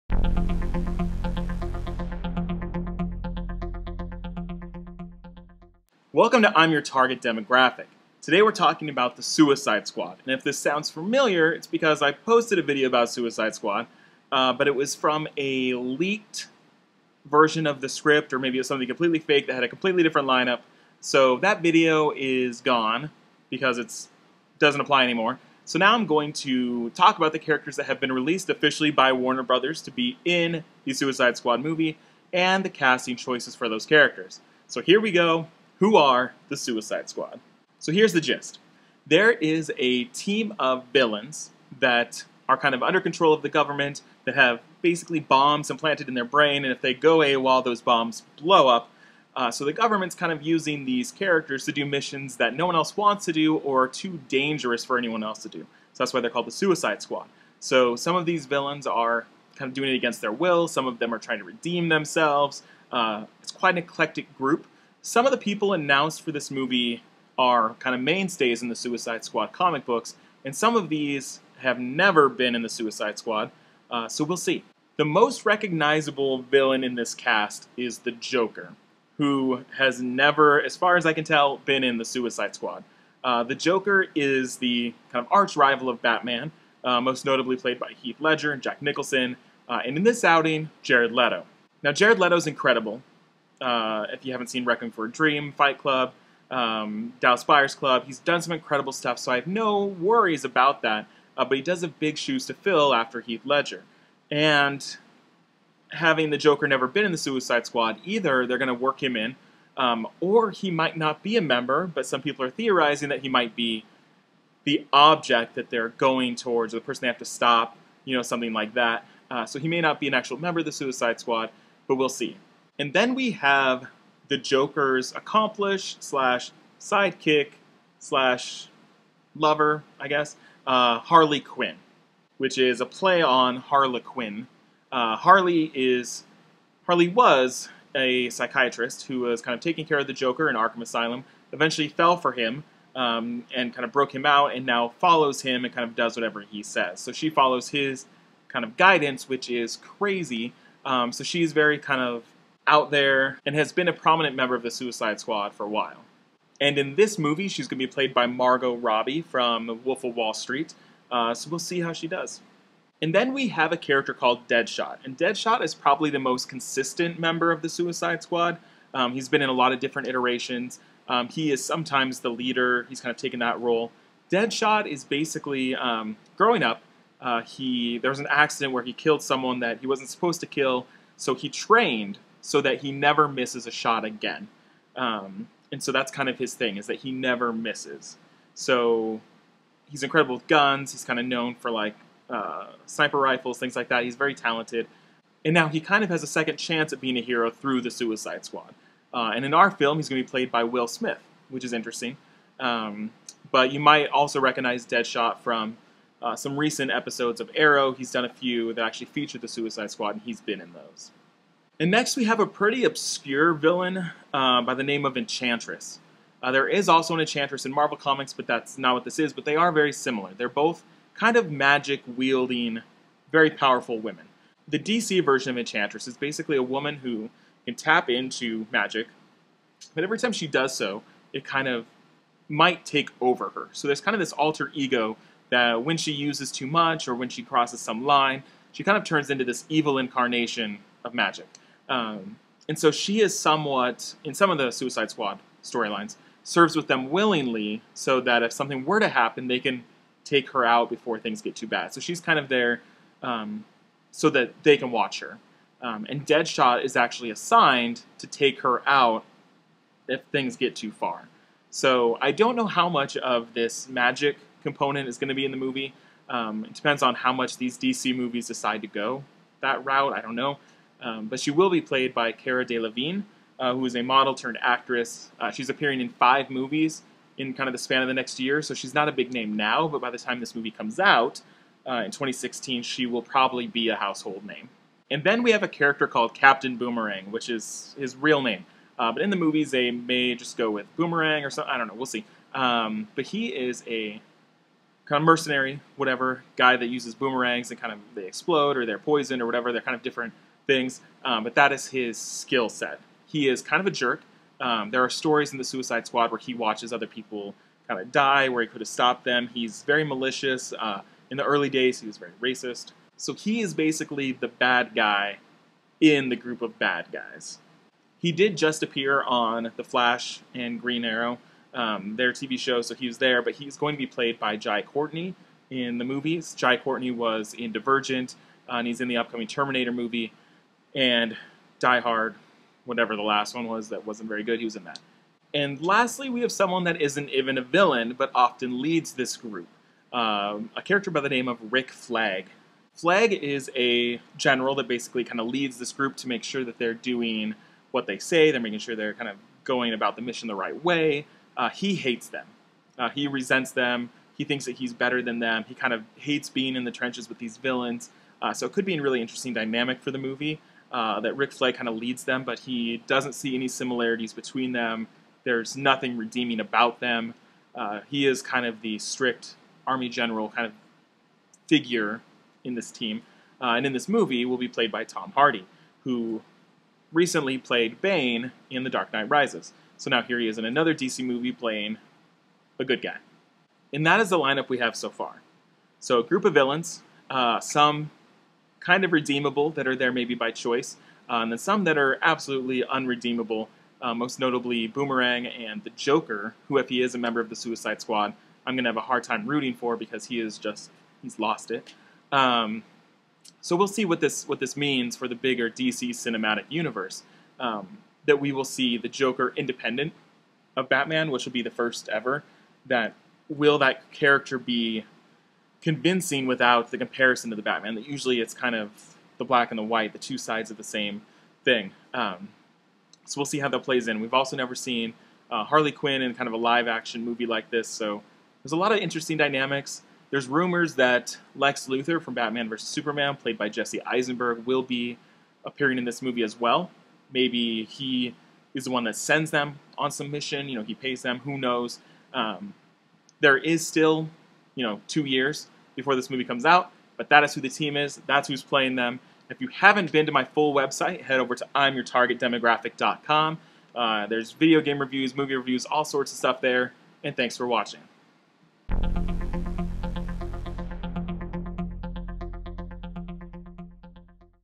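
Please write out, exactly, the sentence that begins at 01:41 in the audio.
Uh, but he does have big shoes to fill after Heath Ledger.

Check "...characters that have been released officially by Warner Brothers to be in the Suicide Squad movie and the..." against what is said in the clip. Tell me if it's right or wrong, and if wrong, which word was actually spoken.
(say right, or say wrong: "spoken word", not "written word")
right.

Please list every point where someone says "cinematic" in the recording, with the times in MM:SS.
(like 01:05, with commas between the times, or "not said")
06:46.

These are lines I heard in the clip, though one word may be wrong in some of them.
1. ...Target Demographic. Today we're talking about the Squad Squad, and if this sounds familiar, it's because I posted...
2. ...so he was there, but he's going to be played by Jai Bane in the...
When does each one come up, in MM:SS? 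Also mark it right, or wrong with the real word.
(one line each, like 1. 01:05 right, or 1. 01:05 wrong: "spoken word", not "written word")
1. 00:06 wrong: "Suicide", not "Squad"
2. 05:22 wrong: "Courtney", not "Bane".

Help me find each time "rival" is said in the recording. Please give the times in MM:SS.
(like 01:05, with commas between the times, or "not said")
01:25.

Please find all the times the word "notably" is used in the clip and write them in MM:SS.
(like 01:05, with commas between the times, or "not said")
01:27, 06:34.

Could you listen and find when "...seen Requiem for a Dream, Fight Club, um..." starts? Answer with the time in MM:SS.
01:34.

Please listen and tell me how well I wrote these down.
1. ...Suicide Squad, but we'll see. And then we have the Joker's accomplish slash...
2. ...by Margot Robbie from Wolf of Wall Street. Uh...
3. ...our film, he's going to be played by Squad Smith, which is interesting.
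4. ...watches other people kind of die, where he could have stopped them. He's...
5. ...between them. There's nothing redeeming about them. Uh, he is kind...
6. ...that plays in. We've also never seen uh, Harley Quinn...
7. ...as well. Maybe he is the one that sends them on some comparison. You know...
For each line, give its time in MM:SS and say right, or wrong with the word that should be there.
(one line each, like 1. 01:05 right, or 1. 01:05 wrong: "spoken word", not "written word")
1. 02:00 right
2. 02:38 right
3. 03:19 wrong: "Will", not "Squad"
4. 05:06 right
5. 06:04 right
6. 07:03 right
7. 07:16 wrong: "mission", not "comparison".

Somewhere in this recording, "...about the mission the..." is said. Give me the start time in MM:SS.
05:49.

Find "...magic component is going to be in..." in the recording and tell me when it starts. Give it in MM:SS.
04:23.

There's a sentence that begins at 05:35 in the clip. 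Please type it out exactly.
And lastly, we have someone that isn't even a villain, but often leads this group.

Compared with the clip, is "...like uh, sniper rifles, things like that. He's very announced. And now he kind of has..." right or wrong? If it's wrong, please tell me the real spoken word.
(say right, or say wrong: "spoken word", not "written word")
wrong: "talented", not "announced".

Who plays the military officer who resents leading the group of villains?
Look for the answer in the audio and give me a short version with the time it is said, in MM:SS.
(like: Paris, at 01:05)
Tom Hardy, at 06:15.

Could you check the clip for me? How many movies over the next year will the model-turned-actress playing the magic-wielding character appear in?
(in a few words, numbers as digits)
5.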